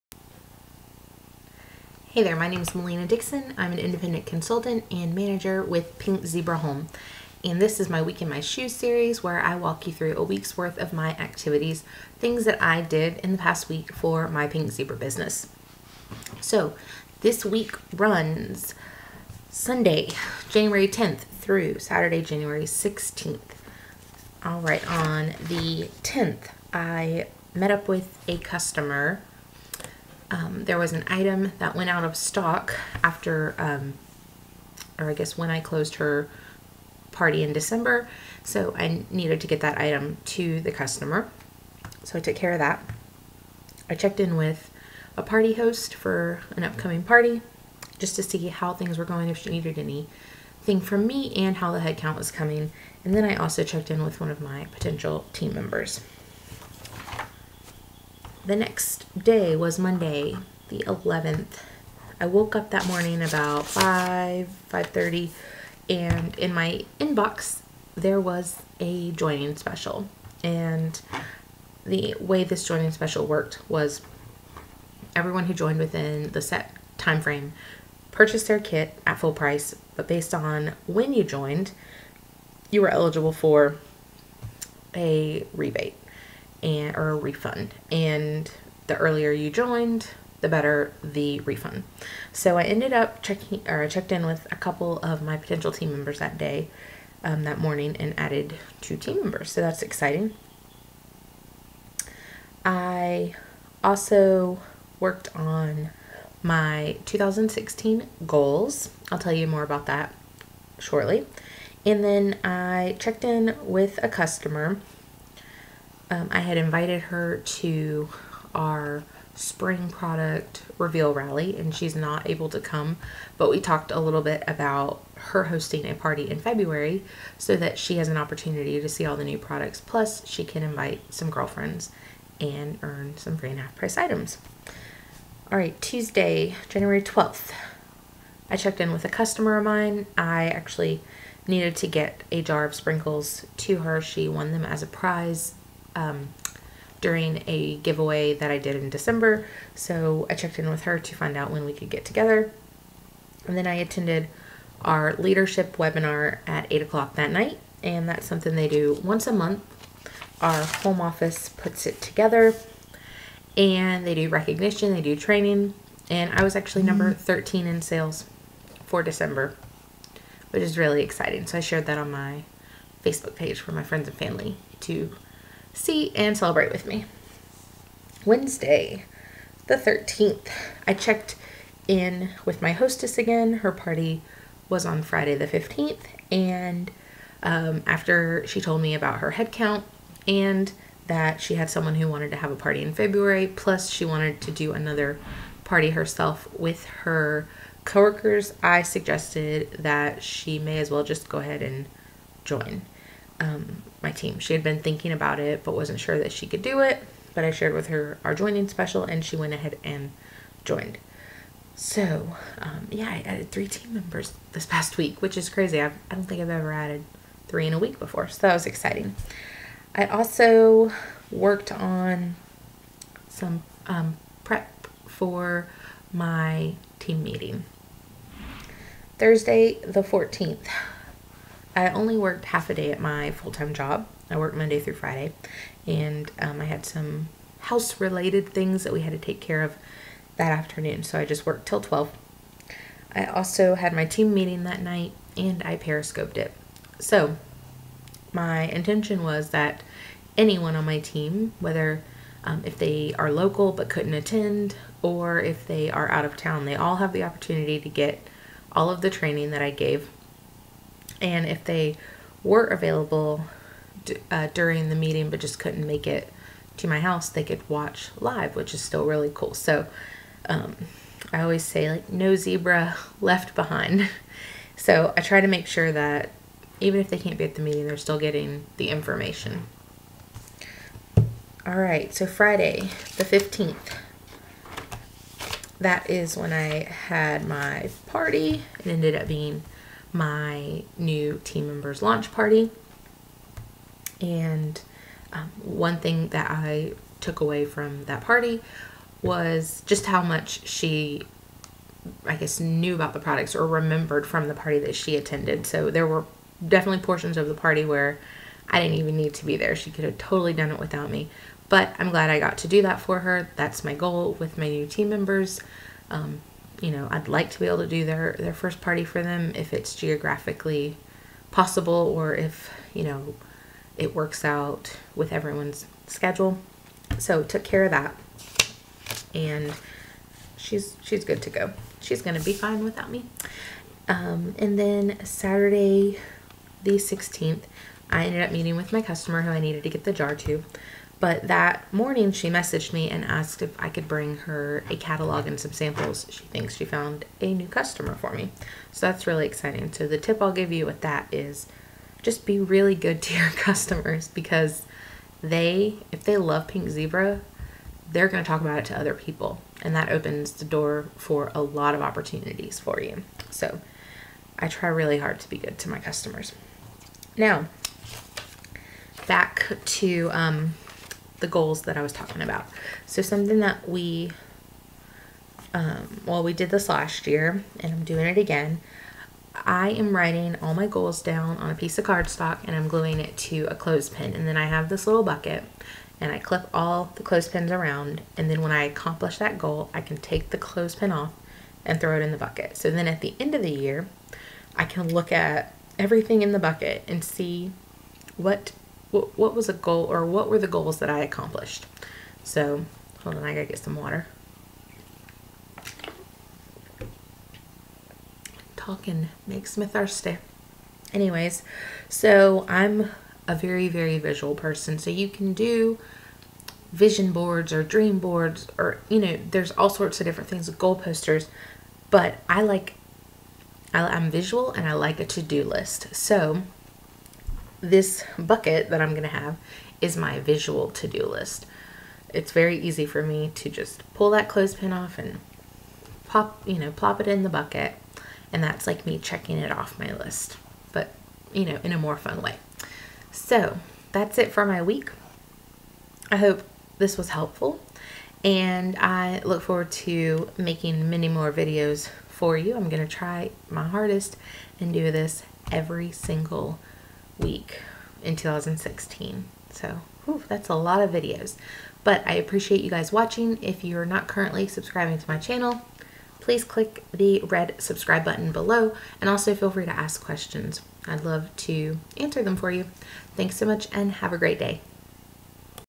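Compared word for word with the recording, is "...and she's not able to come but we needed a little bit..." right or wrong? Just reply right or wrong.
wrong.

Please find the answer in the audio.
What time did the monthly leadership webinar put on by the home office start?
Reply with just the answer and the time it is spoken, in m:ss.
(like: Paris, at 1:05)
8 o'clock, at 2:36.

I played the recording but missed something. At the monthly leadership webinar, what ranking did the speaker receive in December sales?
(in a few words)
13.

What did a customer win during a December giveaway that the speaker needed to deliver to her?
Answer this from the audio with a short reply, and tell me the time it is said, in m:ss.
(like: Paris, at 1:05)
A jar of sprinkles, at 2:22.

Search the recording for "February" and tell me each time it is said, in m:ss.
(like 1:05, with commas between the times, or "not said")
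2:06, 3:12.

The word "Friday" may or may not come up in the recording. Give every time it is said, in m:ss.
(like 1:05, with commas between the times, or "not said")
3:05, 3:54, 4:42.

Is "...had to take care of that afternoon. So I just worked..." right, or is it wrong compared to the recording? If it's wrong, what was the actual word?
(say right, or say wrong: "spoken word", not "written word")
right.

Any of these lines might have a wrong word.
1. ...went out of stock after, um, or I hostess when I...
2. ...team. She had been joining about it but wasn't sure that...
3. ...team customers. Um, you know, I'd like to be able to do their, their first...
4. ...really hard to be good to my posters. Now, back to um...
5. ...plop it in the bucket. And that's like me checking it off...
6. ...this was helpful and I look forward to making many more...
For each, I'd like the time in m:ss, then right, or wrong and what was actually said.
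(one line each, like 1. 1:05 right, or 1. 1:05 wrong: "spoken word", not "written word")
1. 0:31 wrong: "guess", not "hostess"
2. 3:24 wrong: "thinking", not "joining"
3. 5:14 wrong: "members", not "customers"
4. 6:04 wrong: "customers", not "posters"
5. 7:16 right
6. 7:26 right.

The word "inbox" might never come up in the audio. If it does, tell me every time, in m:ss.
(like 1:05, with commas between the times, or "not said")
1:06.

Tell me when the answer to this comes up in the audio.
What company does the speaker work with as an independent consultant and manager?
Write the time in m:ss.
0:05.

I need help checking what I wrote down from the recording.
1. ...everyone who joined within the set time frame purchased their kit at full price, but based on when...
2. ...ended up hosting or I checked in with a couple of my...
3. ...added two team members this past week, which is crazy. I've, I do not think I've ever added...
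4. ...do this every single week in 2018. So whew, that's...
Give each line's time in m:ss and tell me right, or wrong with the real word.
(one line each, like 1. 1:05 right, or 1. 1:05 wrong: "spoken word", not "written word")
1. 1:15 right
2. 1:32 wrong: "checking", not "hosting"
3. 3:33 wrong: "three", not "two"
4. 7:34 wrong: "2016", not "2018".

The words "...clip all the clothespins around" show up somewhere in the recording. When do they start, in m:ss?
6:26.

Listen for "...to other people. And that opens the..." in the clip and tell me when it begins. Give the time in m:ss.
5:58.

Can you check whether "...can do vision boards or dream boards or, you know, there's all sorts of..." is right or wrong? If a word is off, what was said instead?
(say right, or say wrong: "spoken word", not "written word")
right.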